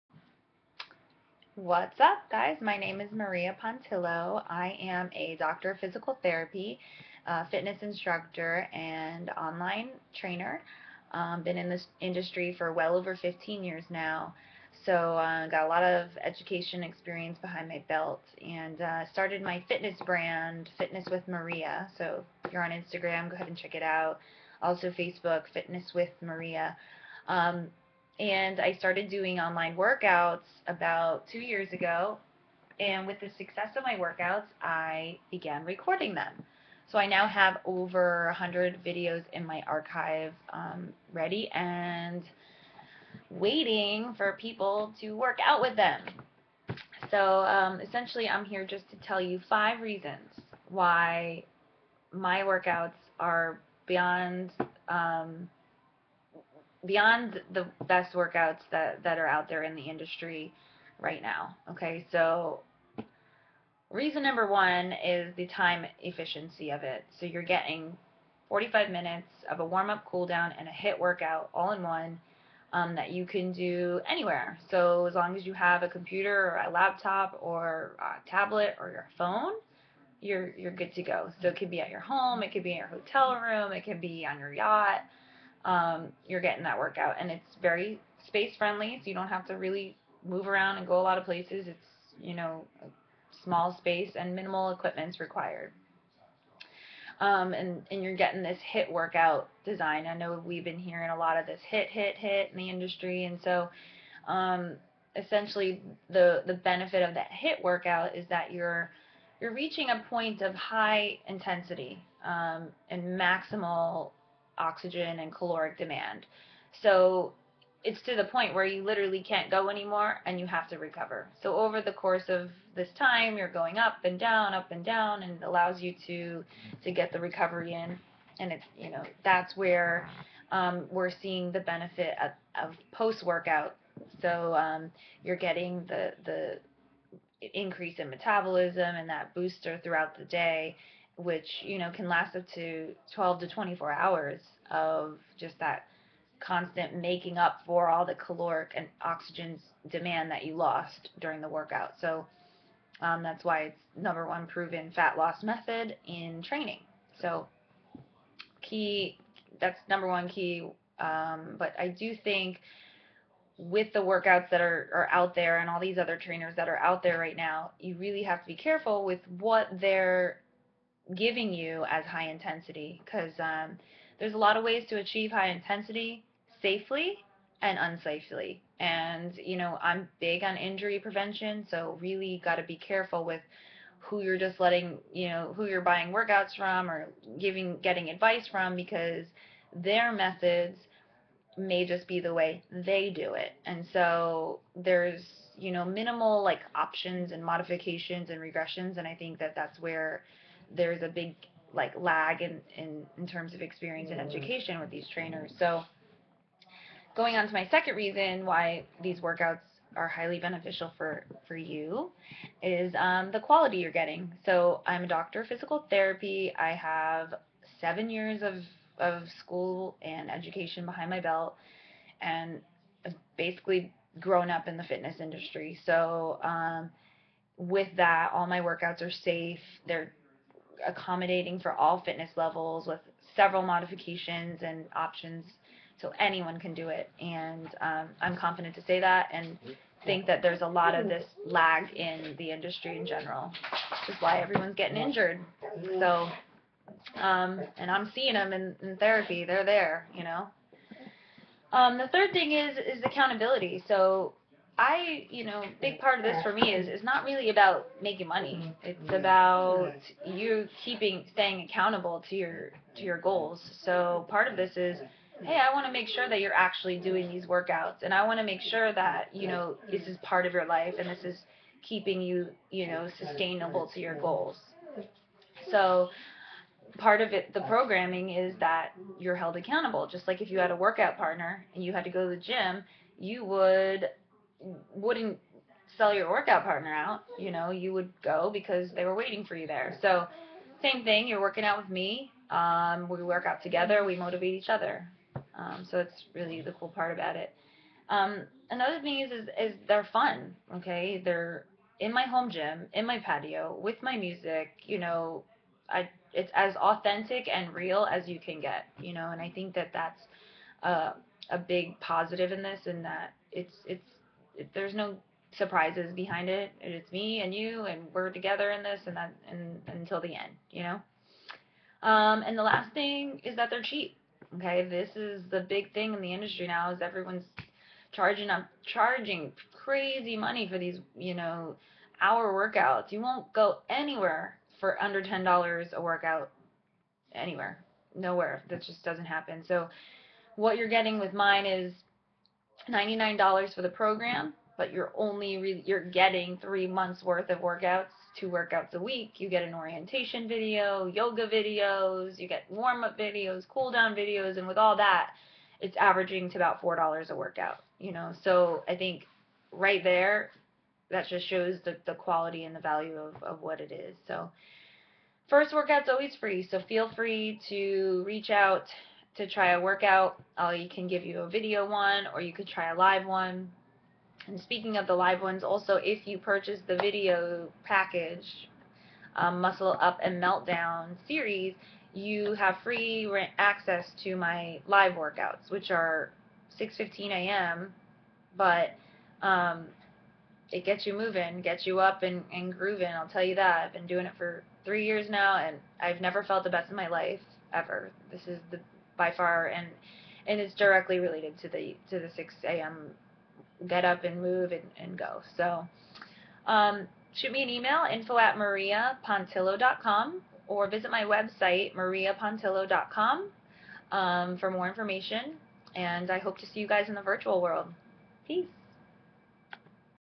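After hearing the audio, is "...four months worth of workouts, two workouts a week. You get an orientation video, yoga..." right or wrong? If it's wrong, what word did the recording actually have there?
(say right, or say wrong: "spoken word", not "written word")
wrong: "three", not "four".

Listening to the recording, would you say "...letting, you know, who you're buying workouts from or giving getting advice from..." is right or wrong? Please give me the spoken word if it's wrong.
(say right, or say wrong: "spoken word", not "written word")
right.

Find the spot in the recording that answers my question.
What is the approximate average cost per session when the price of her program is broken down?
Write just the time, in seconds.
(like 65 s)
356 s.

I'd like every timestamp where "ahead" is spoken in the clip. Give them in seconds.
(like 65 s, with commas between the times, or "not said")
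23 s.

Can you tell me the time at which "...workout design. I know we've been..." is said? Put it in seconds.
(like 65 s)
98 s.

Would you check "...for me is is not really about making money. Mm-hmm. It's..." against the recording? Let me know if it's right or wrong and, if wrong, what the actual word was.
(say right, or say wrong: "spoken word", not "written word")
right.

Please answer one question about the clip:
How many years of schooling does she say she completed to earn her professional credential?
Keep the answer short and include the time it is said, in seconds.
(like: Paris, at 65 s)
7, at 217 s.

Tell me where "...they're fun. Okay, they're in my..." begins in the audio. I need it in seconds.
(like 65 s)
299 s.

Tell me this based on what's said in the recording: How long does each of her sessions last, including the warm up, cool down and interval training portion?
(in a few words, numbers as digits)
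45 minutes.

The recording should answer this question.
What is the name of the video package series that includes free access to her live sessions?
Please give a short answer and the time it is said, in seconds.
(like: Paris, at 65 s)
Muscle Up and Meltdown, at 379 s.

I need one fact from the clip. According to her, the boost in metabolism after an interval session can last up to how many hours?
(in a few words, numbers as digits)
12 to 24 hours.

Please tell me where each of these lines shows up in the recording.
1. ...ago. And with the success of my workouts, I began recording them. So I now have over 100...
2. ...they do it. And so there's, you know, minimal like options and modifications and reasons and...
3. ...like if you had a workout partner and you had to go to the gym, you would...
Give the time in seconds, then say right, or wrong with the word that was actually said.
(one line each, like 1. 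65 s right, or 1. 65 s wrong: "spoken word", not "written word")
1. 31 s right
2. 192 s wrong: "regressions", not "reasons"
3. 280 s right.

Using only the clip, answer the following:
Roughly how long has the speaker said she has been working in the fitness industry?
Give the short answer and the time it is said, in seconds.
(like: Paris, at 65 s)
15 years, at 13 s.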